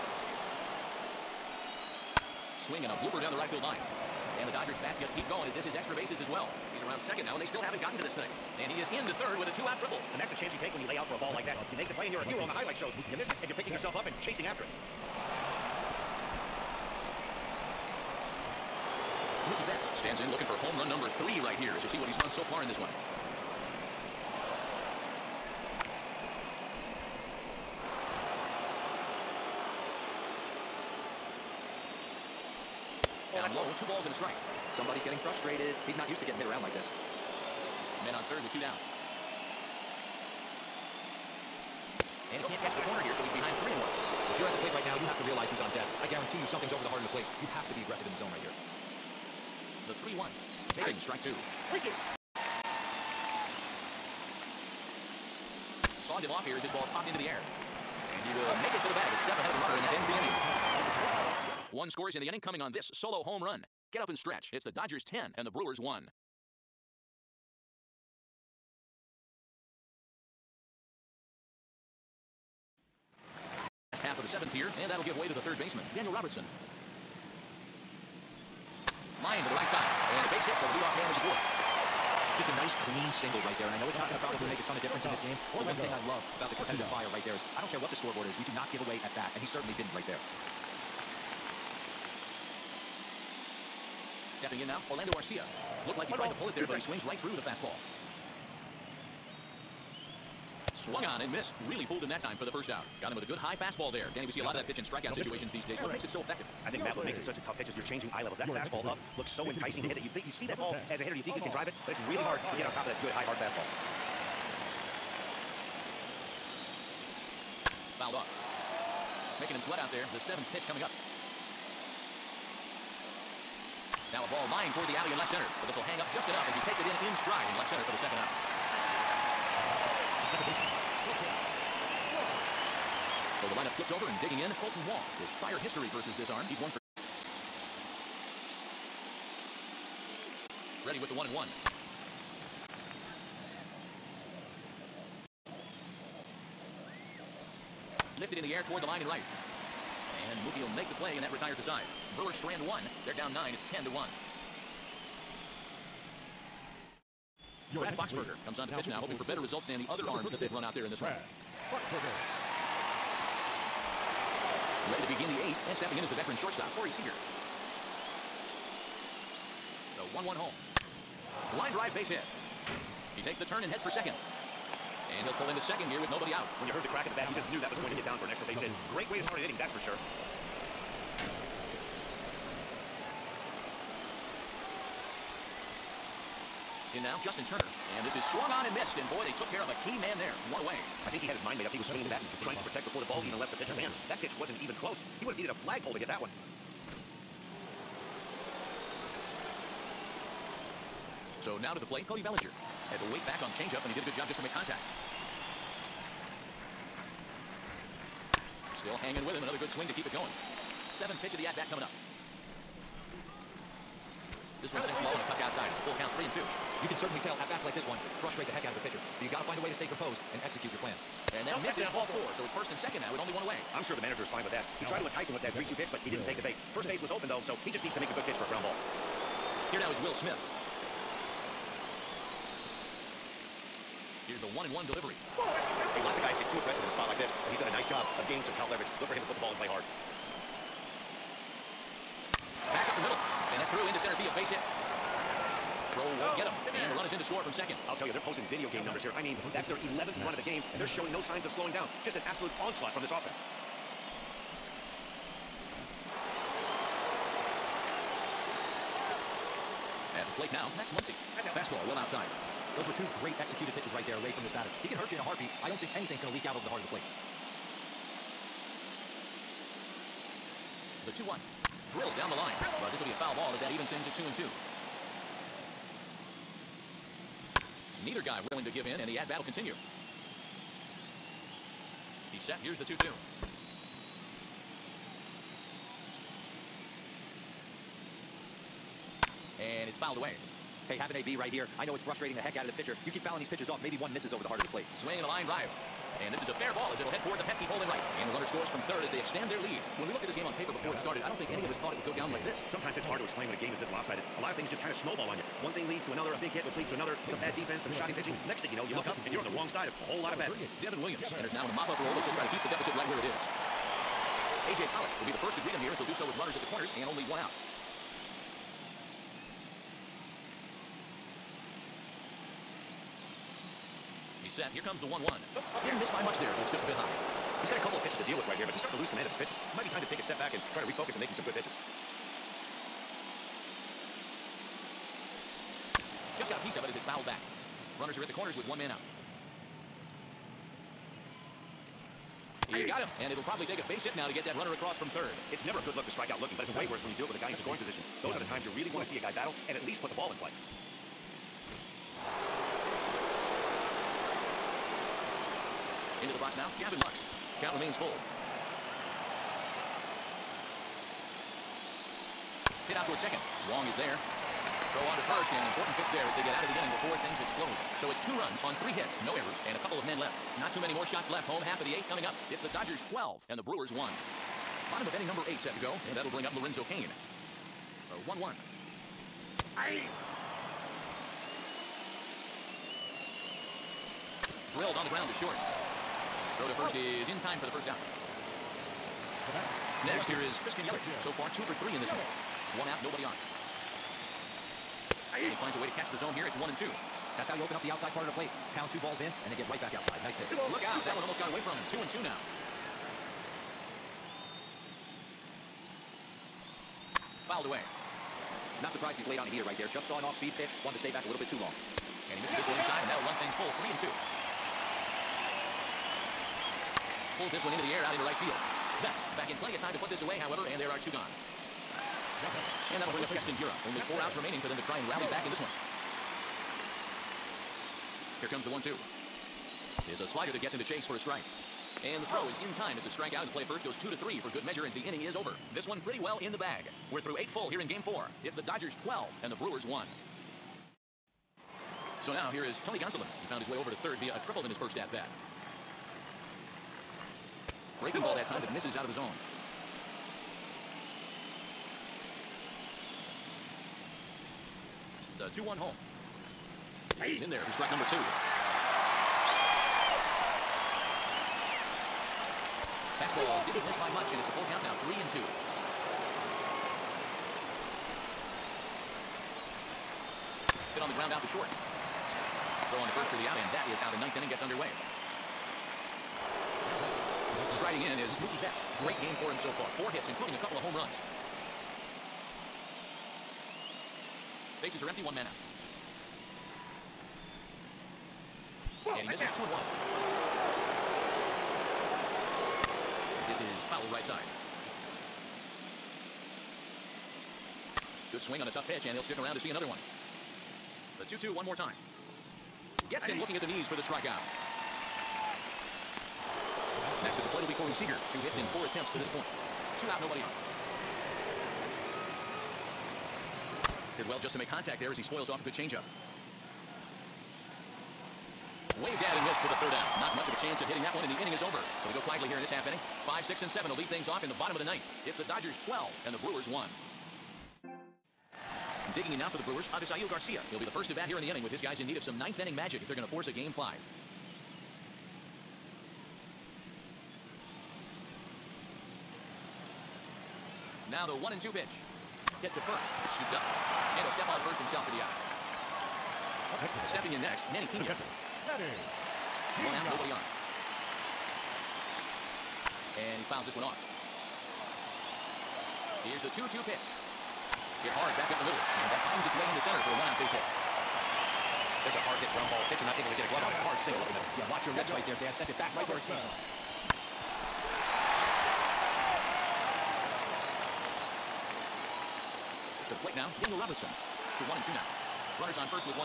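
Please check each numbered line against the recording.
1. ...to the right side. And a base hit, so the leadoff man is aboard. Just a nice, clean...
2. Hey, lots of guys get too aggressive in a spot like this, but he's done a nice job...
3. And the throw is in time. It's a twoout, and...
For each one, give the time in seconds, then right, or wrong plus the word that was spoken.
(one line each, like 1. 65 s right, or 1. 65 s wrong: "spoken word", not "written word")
1. 79 s right
2. 235 s right
3. 432 s wrong: "strikeout", not "twoout".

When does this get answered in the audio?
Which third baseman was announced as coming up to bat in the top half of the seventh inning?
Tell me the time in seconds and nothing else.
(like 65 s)
75 s.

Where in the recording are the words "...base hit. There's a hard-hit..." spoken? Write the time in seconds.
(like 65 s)
560 s.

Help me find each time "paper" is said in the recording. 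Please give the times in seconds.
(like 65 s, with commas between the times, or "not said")
300 s.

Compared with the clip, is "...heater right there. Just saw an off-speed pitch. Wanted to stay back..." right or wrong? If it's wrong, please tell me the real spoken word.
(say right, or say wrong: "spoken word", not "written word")
right.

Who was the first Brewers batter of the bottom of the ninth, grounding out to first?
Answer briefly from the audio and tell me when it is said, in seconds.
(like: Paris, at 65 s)
Avisail Garcia, at 529 s.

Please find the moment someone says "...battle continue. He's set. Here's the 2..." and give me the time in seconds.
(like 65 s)
279 s.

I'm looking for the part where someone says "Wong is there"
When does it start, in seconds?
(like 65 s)
363 s.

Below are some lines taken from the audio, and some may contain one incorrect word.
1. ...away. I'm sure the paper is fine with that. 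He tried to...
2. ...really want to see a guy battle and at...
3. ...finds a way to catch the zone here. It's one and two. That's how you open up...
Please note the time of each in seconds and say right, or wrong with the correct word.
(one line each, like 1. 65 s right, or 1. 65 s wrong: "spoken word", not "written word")
1. 223 s wrong: "manager", not "paper"
2. 348 s right
3. 395 s right.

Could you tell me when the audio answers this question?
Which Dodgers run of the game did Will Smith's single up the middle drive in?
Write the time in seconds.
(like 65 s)
249 s.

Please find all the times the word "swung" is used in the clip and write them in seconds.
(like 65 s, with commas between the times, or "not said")
100 s, 188 s.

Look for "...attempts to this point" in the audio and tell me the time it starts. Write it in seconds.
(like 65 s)
508 s.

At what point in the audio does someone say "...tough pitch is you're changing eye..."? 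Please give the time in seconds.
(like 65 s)
107 s.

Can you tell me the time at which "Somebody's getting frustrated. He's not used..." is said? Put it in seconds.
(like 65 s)
34 s.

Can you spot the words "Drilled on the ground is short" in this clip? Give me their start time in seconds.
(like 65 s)
384 s.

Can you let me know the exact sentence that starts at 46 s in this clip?
I guarantee you something's over the heart of the plate.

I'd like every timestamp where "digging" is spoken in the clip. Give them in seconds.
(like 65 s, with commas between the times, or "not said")
134 s, 529 s.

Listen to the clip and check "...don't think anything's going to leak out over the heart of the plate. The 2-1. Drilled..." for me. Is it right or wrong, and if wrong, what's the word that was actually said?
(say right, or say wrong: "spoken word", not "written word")
right.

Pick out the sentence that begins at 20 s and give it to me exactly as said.
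looking for home run number three right here as you see what he's done so far in this one.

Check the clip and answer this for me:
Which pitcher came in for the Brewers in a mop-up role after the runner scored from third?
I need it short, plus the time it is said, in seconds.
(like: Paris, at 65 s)
Devin Williams, at 310 s.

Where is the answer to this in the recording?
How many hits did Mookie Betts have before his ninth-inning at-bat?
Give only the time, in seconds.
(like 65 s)
479 s.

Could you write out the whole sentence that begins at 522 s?
So they go quietly here in this half inning.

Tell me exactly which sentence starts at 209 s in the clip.
Another good swing to keep it going.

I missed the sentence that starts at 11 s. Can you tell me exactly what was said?
You make the play, and you're a hero on the highlight shows.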